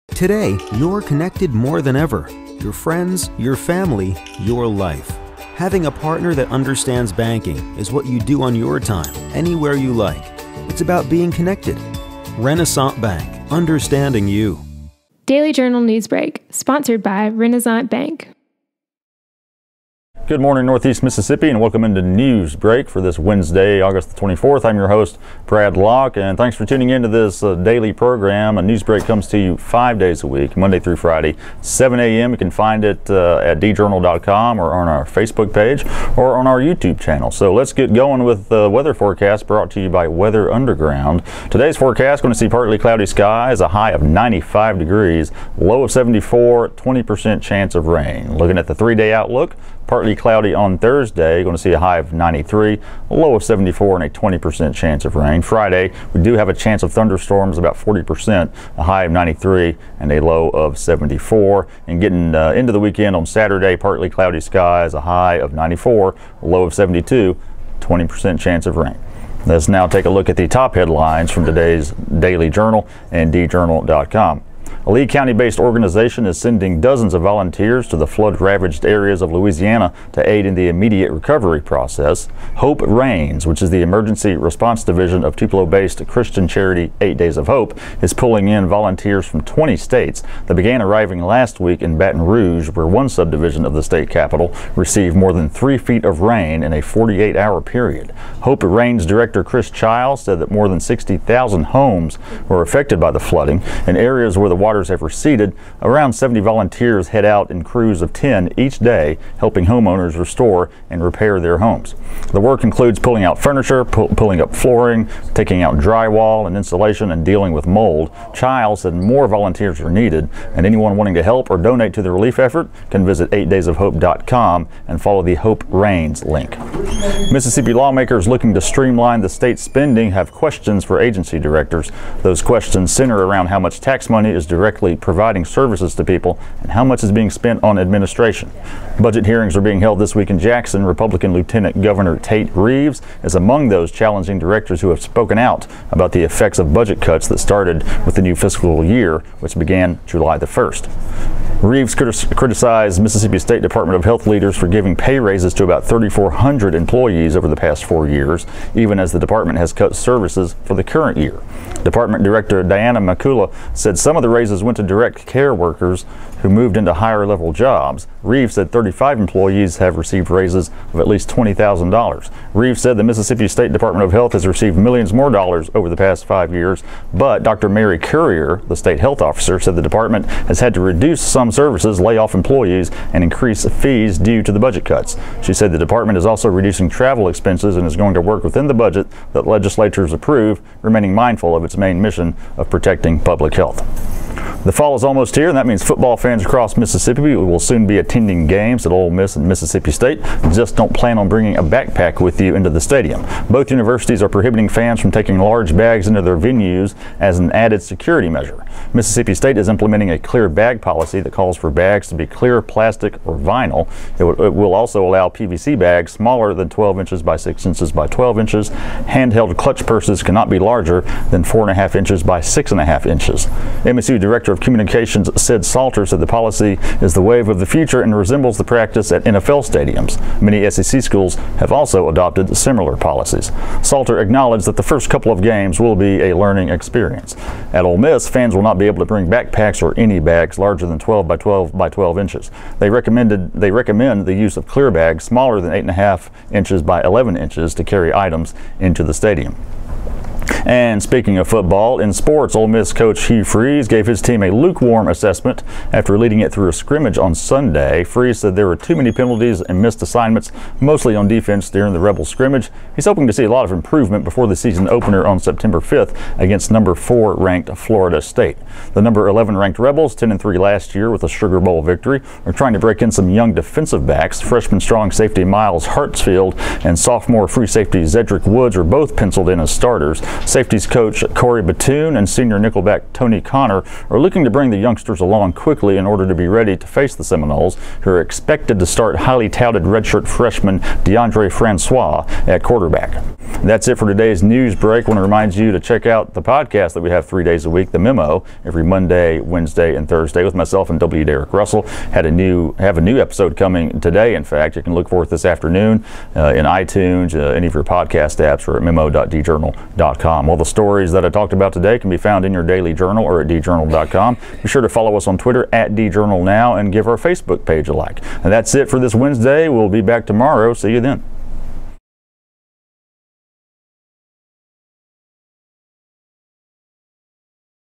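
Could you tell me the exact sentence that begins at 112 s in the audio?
The work includes pulling out furniture, pu pulling up flooring, taking out drywall and insulation, and dealing with mold.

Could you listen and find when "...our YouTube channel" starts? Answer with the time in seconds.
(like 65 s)
36 s.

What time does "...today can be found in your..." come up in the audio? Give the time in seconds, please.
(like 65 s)
311 s.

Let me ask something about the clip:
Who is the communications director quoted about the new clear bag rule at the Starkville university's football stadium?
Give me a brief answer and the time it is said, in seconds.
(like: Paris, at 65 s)
Sid Salter, at 225 s.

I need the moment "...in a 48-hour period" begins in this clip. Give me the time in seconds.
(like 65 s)
96 s.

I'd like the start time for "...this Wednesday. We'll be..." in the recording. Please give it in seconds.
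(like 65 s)
318 s.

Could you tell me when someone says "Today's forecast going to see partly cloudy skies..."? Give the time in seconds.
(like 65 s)
41 s.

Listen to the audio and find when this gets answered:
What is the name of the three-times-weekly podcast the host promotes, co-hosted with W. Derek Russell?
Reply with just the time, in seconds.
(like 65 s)
297 s.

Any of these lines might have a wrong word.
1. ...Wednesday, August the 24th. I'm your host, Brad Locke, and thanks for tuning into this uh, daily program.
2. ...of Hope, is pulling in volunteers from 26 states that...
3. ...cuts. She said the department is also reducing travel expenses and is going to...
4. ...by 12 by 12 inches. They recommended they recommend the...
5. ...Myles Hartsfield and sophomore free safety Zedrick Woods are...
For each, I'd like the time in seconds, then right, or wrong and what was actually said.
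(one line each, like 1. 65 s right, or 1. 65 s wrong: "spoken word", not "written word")
1. 23 s right
2. 87 s wrong: "20", not "26"
3. 184 s right
4. 241 s right
5. 275 s right.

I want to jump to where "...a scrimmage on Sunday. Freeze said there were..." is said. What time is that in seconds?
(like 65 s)
256 s.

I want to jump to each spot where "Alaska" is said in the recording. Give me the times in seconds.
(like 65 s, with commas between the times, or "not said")
not said.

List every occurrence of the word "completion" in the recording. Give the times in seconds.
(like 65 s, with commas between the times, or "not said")
not said.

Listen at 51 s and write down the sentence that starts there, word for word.
You're going to see a high of 93, a low of 74, and a 20% chance of rain.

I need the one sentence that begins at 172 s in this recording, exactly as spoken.
Reeves said the Mississippi State Department of Health has received millions more dollars over the past five years, but Dr.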